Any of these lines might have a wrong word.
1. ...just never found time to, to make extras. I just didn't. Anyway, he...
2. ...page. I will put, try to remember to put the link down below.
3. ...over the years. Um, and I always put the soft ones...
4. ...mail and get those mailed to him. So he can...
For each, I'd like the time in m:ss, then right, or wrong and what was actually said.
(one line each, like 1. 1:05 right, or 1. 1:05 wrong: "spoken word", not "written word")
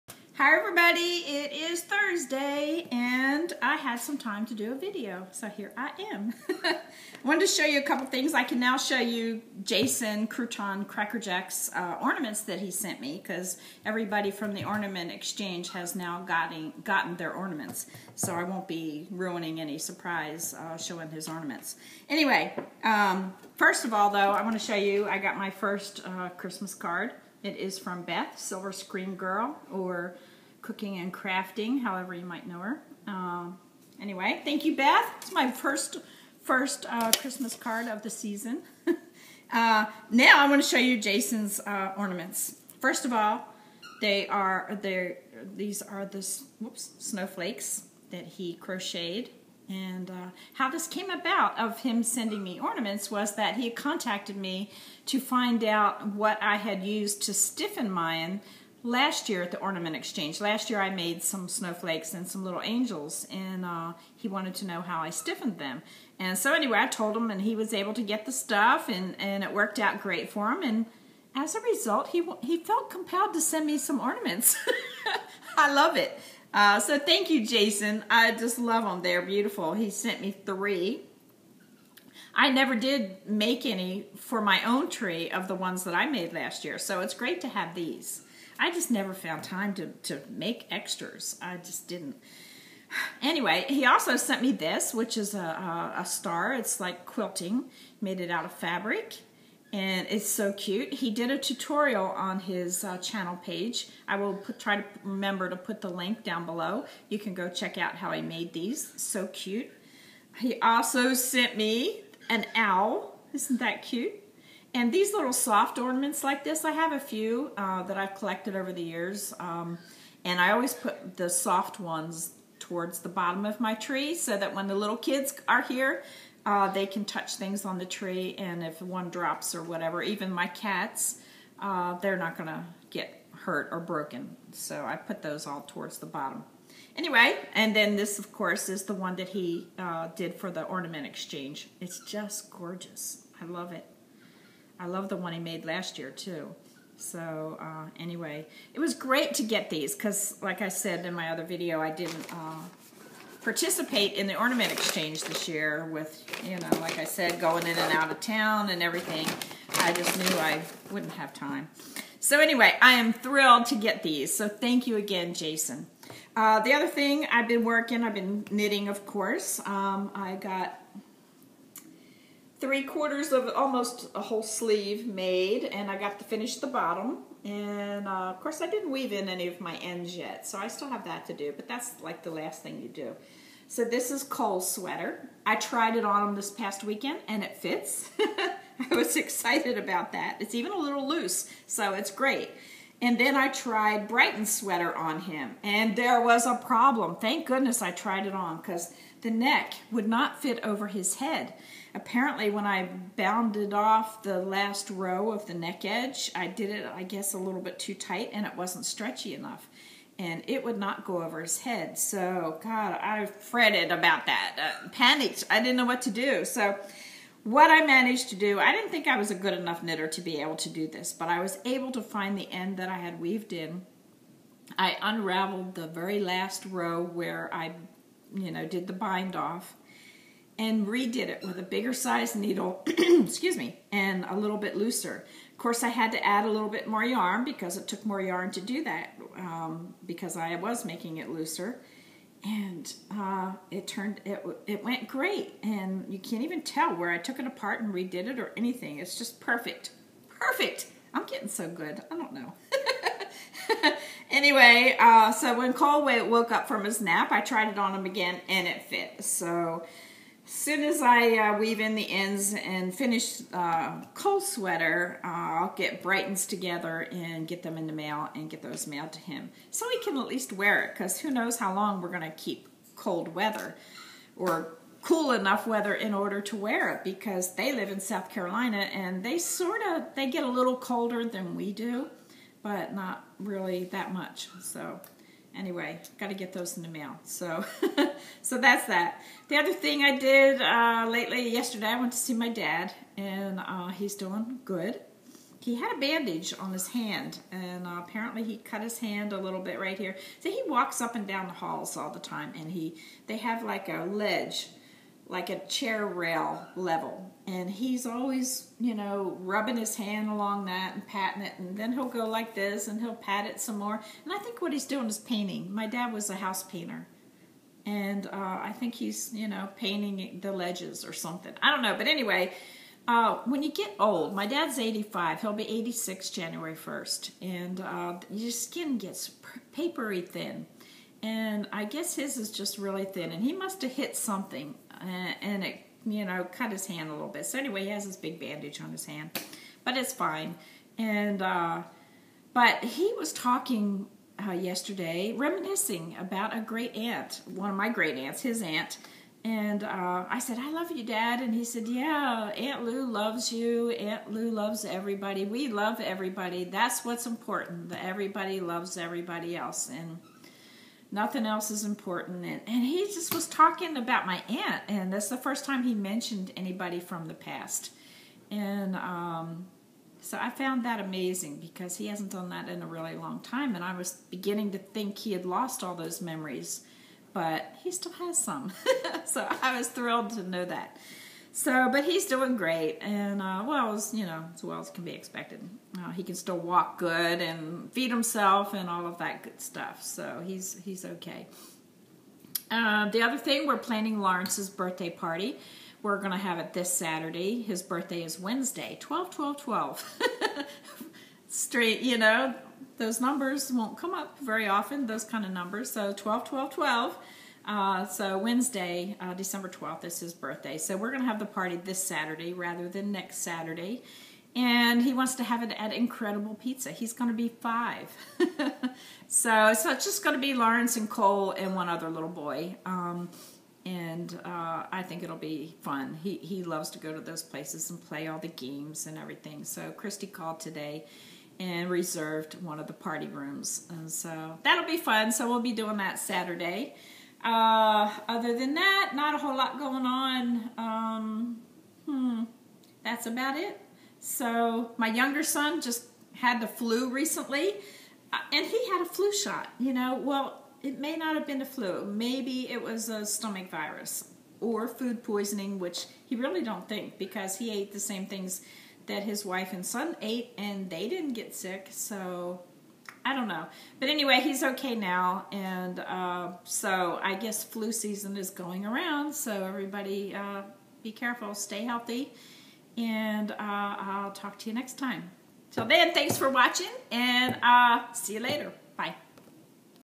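1. 1:28 right
2. 1:43 right
3. 1:58 right
4. 4:27 right.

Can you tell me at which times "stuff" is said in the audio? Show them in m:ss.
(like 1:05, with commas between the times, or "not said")
1:08, 6:29.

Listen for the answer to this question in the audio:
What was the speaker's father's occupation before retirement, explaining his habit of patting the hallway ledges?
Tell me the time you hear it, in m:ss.
5:16.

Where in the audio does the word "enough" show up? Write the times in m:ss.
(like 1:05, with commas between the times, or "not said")
3:29, 3:39, 4:35.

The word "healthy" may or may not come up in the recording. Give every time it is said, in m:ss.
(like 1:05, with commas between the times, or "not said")
7:51.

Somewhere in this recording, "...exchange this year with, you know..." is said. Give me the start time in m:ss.
2:34.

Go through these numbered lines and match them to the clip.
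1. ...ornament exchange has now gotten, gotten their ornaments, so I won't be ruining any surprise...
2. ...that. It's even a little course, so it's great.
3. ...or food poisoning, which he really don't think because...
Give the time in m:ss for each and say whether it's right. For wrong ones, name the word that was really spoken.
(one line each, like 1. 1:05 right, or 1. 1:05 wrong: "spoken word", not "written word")
1. 0:14 right
2. 3:10 wrong: "loose", not "course"
3. 7:34 right.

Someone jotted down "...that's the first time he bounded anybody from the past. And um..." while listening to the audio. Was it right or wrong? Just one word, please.
wrong.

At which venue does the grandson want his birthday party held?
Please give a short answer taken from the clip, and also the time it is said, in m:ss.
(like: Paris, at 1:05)
Incredible Pizza, at 6:55.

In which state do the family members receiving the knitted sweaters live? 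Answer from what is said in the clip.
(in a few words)
South Carolina.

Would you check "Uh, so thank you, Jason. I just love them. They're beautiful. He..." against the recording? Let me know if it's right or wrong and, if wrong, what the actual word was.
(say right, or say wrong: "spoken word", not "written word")
right.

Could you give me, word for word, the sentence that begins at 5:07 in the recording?
And he's always, you know, rubbing his hand along that and patting it.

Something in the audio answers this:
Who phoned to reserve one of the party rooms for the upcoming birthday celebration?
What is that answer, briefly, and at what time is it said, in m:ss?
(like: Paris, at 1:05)
Christy, at 7:09.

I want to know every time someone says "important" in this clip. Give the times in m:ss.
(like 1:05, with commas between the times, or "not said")
5:57, 6:01.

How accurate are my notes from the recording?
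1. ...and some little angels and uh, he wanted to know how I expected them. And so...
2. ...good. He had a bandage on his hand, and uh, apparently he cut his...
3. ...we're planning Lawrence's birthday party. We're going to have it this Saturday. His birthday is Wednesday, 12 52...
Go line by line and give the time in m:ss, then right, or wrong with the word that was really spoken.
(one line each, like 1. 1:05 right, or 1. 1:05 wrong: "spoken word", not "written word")
1. 1:02 wrong: "stiffened", not "expected"
2. 4:54 right
3. 6:33 wrong: "12", not "52".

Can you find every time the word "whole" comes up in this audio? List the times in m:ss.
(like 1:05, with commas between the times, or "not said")
2:54, 7:19.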